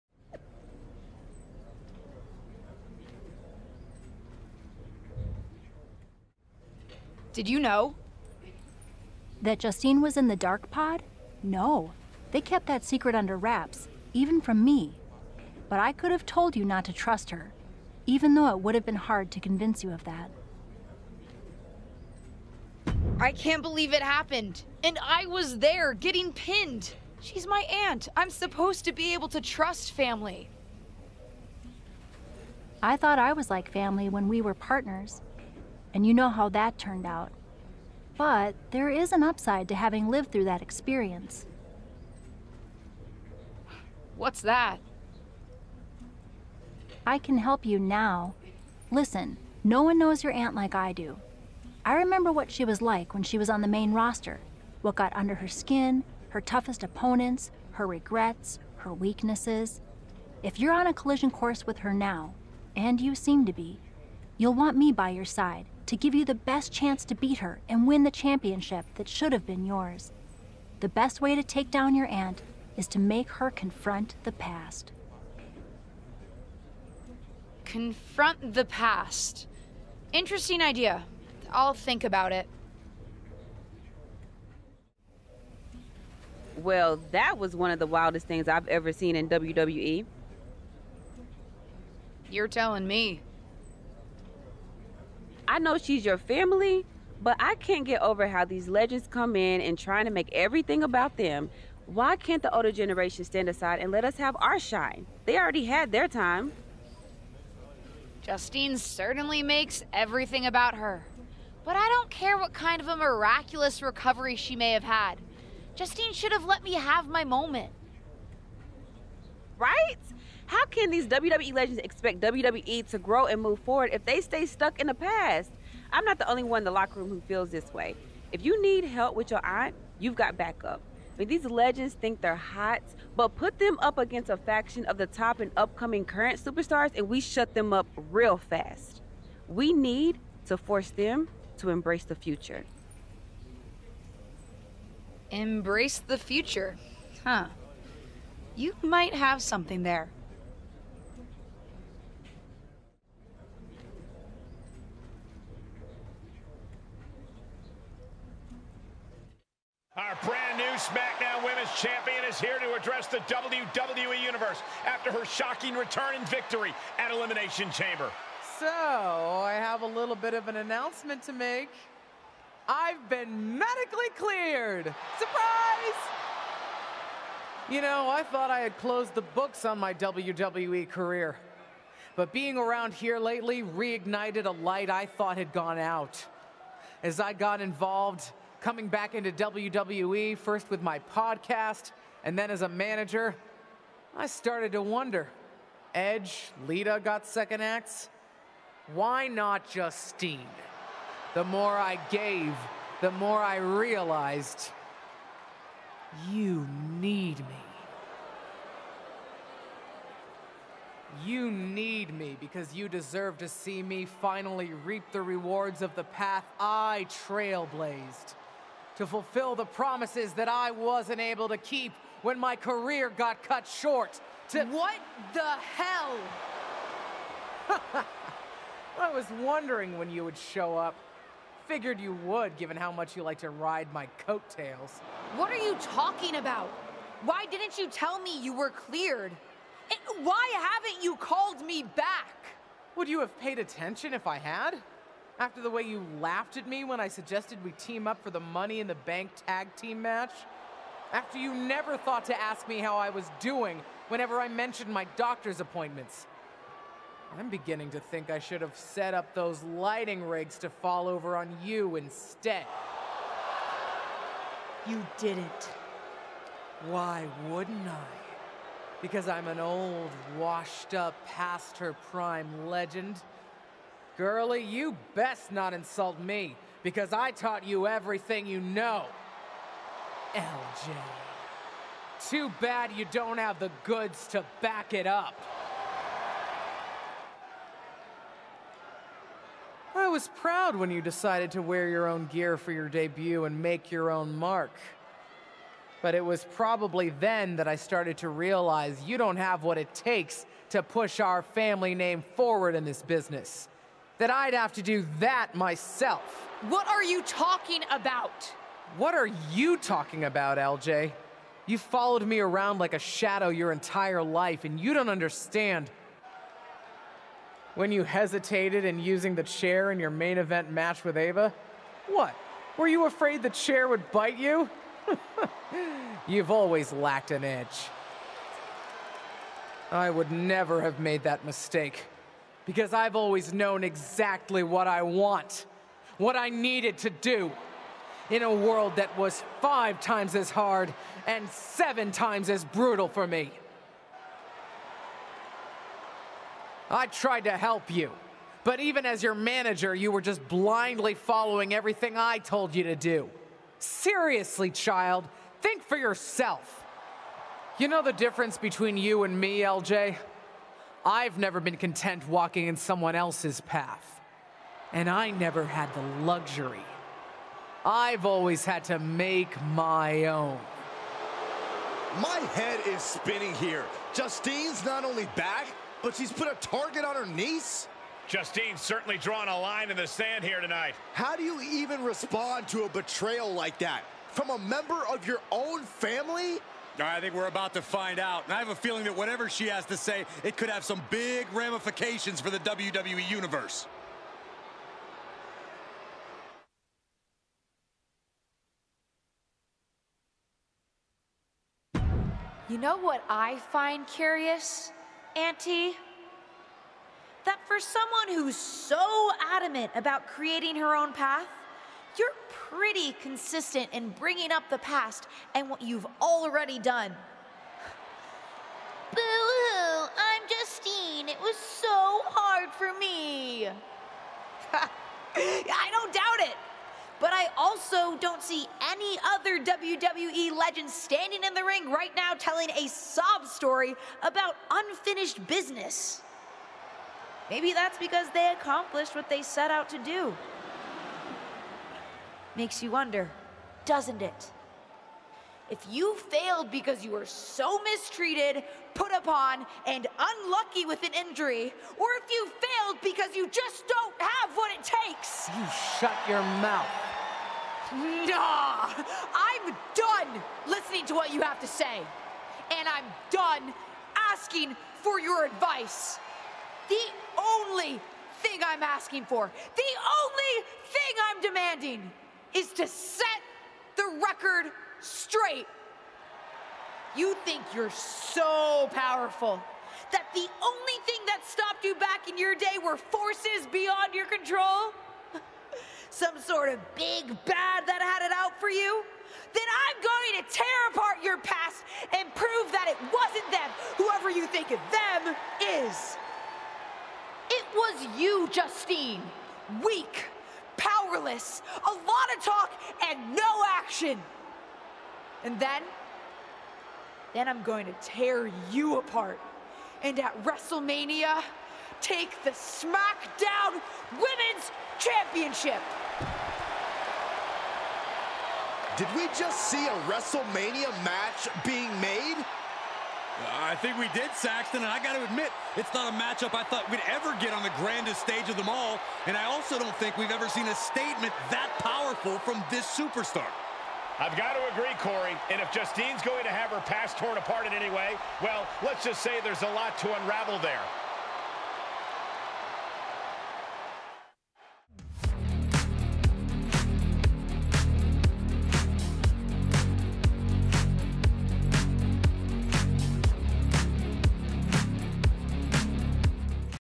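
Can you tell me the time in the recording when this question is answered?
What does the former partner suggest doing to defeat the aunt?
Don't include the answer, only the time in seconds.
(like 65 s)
72 s.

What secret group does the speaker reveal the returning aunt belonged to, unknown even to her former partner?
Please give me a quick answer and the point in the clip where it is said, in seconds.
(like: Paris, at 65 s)
the dark pod, at 10 s.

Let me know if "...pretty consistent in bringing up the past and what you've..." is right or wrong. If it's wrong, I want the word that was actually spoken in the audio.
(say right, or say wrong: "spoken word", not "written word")
right.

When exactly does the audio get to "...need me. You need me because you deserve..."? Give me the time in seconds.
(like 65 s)
206 s.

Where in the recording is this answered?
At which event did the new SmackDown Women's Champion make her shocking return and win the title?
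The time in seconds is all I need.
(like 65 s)
167 s.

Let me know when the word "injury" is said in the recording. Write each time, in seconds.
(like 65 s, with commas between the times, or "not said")
451 s.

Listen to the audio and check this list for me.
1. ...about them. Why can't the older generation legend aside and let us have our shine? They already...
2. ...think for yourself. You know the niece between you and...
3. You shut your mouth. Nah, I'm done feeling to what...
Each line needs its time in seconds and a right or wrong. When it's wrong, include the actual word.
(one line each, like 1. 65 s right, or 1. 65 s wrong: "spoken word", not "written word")
1. 100 s wrong: "stand", not "legend"
2. 355 s wrong: "difference", not "niece"
3. 455 s wrong: "listening", not "feeling".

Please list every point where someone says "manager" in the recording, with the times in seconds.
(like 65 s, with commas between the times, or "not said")
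192 s, 349 s.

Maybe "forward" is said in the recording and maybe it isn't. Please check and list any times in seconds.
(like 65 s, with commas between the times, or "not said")
123 s, 302 s.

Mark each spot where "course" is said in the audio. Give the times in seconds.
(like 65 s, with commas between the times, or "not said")
61 s.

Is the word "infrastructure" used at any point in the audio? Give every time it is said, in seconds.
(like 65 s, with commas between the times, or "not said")
not said.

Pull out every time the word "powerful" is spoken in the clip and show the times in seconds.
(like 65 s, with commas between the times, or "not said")
478 s, 531 s.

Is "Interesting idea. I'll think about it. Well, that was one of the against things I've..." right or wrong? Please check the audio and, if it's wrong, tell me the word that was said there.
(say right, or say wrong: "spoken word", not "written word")
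wrong: "wildest", not "against".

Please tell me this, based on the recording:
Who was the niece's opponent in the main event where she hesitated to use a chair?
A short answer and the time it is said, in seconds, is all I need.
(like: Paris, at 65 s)
Ava, at 321 s.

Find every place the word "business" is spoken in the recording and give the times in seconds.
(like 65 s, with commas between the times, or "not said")
303 s, 435 s.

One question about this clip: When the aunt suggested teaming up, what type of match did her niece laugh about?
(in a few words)
Money in the Bank tag team match.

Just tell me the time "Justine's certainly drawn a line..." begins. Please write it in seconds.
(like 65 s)
378 s.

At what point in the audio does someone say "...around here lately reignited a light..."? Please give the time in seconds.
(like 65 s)
182 s.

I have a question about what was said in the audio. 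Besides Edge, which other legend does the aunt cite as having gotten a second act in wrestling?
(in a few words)
Lita.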